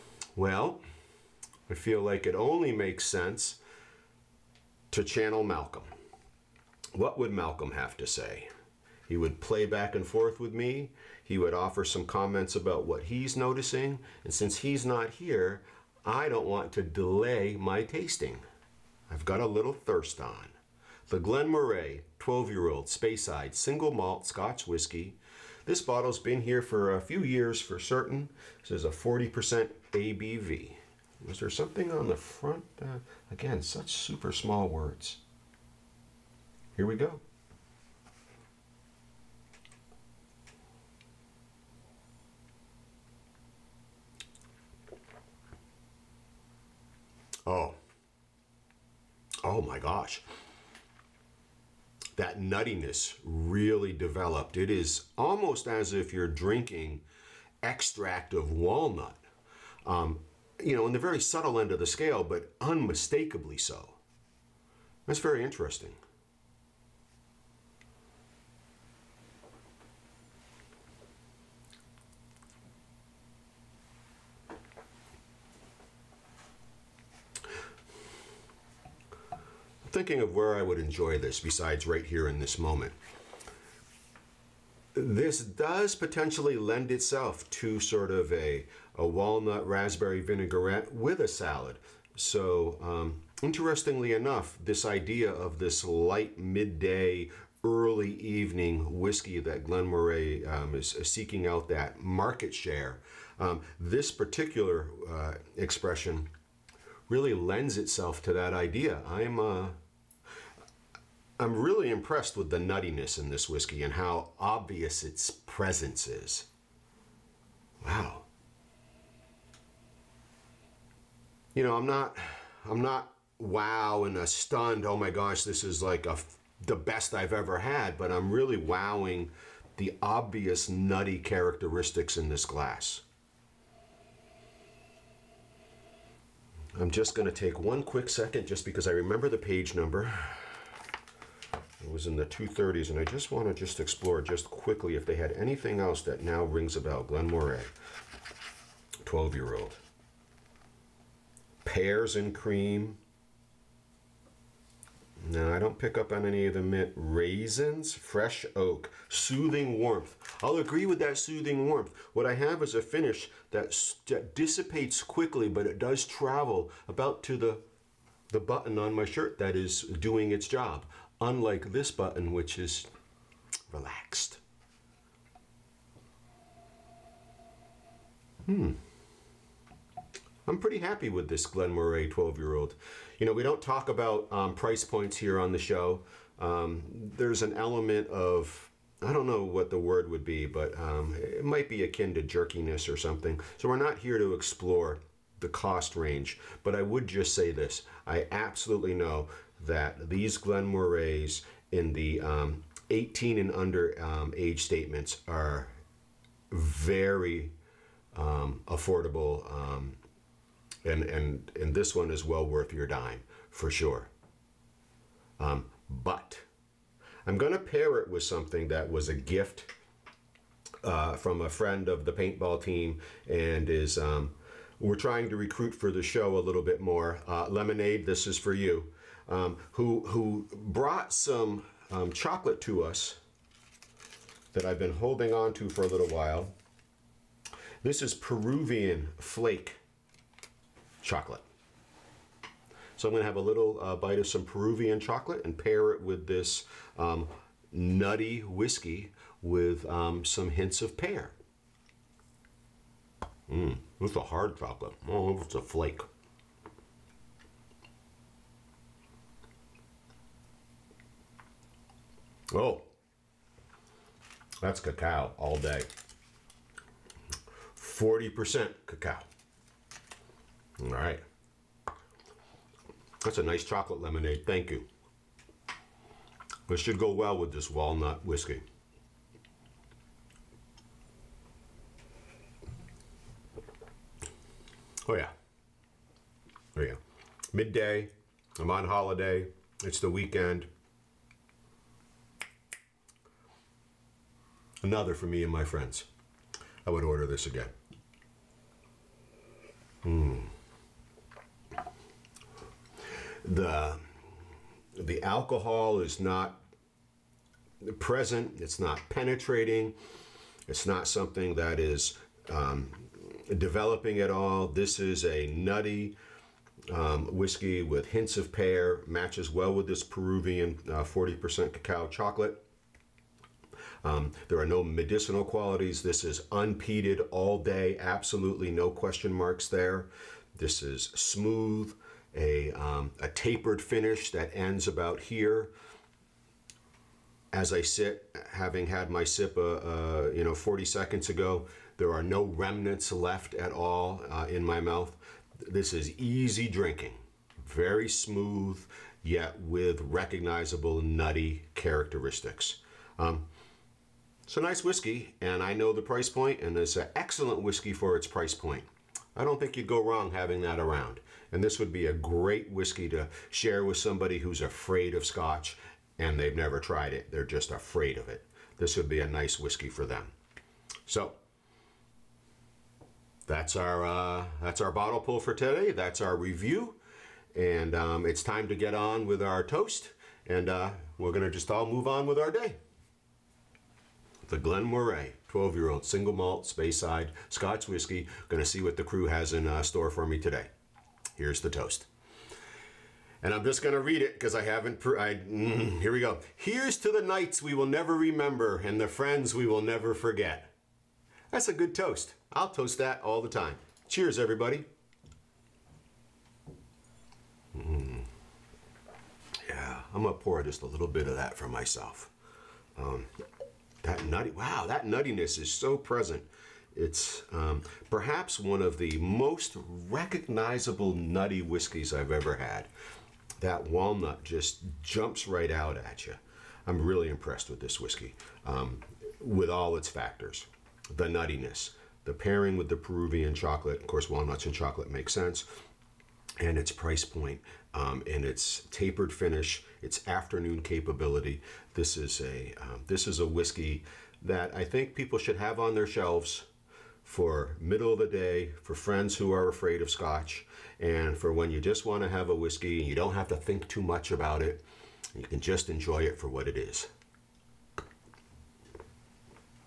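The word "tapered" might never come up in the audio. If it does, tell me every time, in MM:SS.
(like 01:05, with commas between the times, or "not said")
05:33, 07:18.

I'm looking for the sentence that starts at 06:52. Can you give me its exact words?
Um, that nutty, wow, that nuttiness is so present.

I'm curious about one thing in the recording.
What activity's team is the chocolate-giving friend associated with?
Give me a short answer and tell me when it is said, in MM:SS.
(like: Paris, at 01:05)
paintball, at 03:42.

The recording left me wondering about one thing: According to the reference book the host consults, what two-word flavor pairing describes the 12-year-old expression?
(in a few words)
Pears and cream.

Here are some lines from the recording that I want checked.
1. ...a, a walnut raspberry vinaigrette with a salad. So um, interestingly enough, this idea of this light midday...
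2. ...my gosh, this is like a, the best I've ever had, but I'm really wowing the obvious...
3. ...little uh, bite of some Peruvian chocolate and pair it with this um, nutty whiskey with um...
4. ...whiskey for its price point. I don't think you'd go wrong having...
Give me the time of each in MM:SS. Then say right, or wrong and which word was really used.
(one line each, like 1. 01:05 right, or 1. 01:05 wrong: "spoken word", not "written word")
1. 01:28 right
2. 02:04 right
3. 04:03 right
4. 05:57 right.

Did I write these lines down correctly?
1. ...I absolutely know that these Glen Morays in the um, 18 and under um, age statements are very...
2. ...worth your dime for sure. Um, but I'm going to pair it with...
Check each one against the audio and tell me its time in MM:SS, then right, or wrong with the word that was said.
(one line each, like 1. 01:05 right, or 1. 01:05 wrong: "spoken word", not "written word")
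1. 03:18 right
2. 03:32 right.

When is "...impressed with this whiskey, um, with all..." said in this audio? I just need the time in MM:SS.
07:07.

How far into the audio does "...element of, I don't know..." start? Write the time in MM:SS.
03:07.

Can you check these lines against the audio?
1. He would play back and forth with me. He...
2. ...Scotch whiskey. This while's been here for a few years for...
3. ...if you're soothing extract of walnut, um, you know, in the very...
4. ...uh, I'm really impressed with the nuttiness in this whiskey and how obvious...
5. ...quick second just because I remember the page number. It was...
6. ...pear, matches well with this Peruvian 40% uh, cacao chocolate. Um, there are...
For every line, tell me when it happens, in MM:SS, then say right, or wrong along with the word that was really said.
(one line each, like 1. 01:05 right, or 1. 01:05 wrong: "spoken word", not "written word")
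1. 00:09 right
2. 00:24 wrong: "bottle", not "while"
3. 00:55 wrong: "drinking", not "soothing"
4. 01:49 right
5. 02:17 right
6. 05:18 right.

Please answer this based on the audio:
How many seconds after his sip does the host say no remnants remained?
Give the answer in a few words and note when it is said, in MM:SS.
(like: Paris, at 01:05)
40 seconds, at 05:40.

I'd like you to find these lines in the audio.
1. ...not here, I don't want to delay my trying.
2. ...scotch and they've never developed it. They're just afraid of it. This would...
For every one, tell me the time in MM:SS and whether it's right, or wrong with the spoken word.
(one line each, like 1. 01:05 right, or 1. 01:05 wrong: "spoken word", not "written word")
1. 00:14 wrong: "tasting", not "trying"
2. 06:05 wrong: "tried", not "developed".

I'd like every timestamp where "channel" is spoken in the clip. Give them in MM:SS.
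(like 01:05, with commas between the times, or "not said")
00:05.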